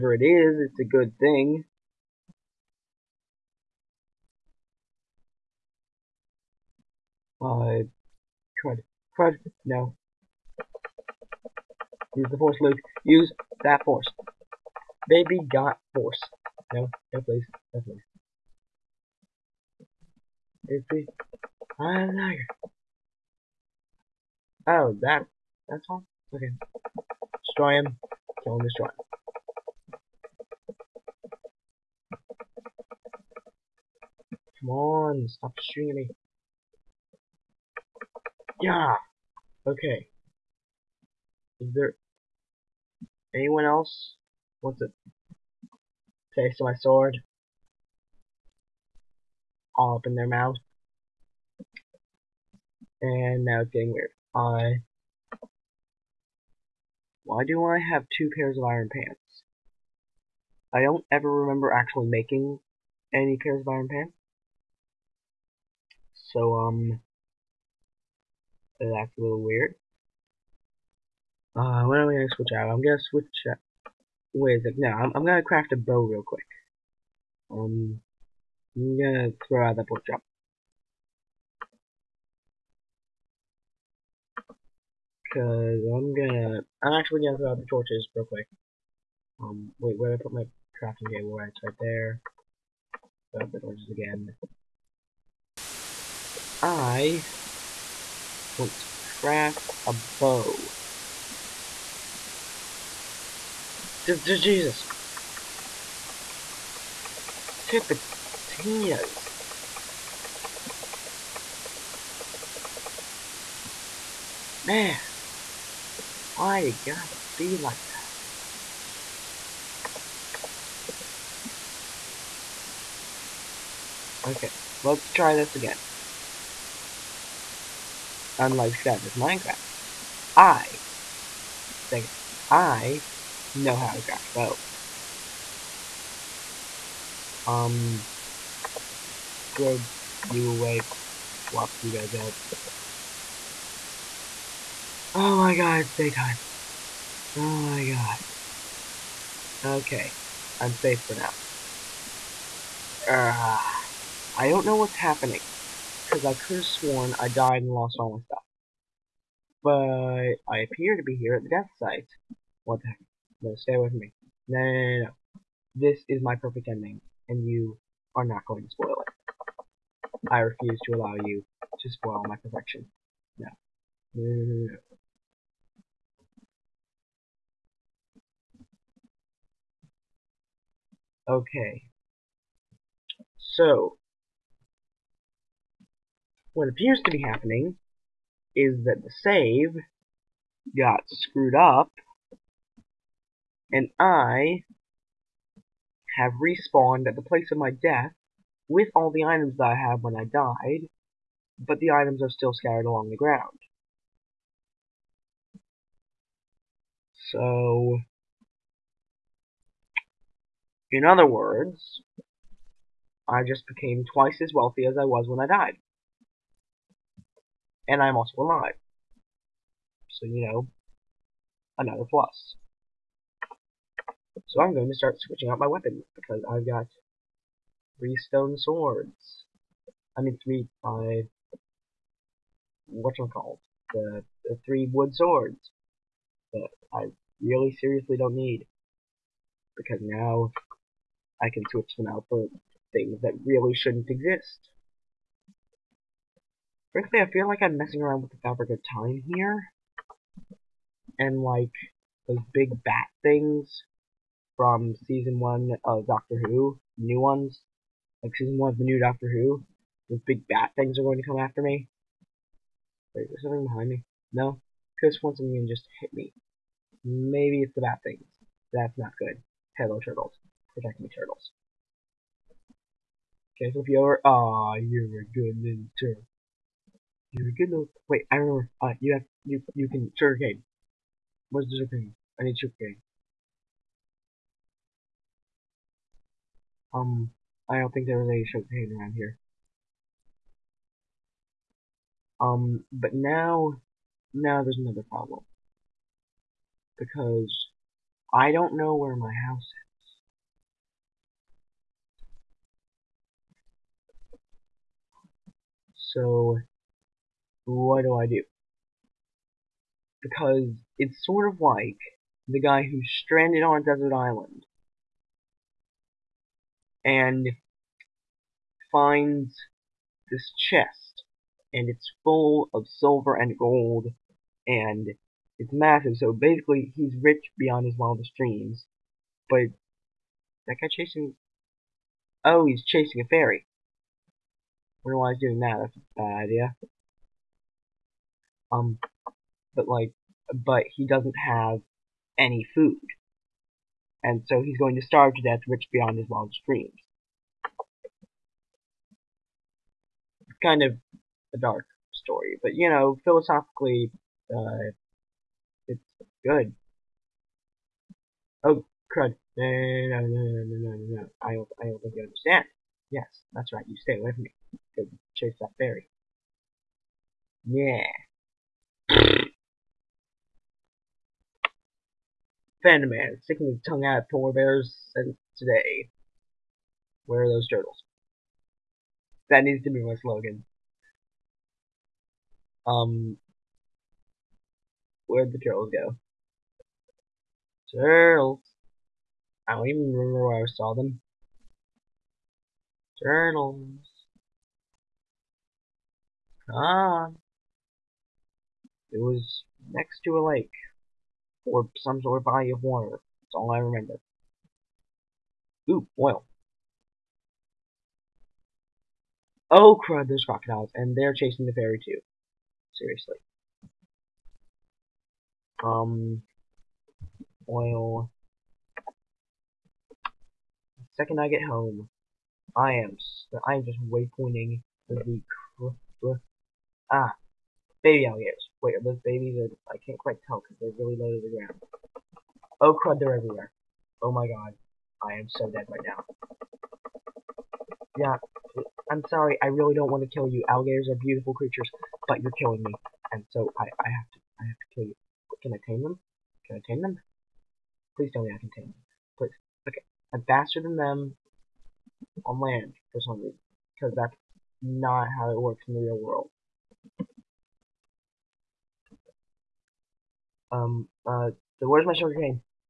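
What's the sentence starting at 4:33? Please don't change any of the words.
Okay, so if you are ah, you're a good little turtle.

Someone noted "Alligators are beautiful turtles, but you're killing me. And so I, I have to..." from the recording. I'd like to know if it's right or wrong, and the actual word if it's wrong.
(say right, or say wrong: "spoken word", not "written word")
wrong: "creatures", not "turtles".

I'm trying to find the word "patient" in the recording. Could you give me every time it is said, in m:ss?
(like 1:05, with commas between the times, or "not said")
not said.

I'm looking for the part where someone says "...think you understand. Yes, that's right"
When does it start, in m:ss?
6:02.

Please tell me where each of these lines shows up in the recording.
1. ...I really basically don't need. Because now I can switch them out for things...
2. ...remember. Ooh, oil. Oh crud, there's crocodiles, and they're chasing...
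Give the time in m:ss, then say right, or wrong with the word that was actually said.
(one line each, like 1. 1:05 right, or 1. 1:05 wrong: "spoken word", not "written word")
1. 3:56 wrong: "seriously", not "basically"
2. 6:43 right.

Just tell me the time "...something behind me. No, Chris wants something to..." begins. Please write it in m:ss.
4:23.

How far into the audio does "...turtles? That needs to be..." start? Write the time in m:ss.
6:17.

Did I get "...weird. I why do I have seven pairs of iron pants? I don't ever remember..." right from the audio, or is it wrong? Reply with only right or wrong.
wrong.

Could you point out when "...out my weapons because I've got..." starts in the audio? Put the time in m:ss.
3:45.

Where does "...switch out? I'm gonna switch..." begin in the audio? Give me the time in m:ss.
1:12.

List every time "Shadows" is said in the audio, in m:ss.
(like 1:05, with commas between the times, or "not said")
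2:08.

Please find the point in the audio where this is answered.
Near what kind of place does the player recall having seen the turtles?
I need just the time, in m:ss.
6:40.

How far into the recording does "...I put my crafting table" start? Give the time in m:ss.
1:30.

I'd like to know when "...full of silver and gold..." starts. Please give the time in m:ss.
5:22.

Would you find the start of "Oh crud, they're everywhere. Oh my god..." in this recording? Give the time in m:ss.
7:12.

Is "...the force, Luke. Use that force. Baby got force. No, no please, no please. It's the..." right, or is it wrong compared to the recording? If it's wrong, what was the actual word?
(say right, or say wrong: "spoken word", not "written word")
right.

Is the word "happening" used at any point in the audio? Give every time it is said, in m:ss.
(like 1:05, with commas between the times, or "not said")
2:34, 3:07.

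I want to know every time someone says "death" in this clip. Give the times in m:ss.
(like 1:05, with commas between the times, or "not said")
2:41, 3:17, 5:45.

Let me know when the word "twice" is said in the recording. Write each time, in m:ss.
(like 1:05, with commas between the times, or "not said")
3:34.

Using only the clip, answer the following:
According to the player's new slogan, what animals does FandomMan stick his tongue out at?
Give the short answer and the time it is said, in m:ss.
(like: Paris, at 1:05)
Polar bears, at 6:14.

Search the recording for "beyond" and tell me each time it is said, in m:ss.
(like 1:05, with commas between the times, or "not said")
5:27, 5:45.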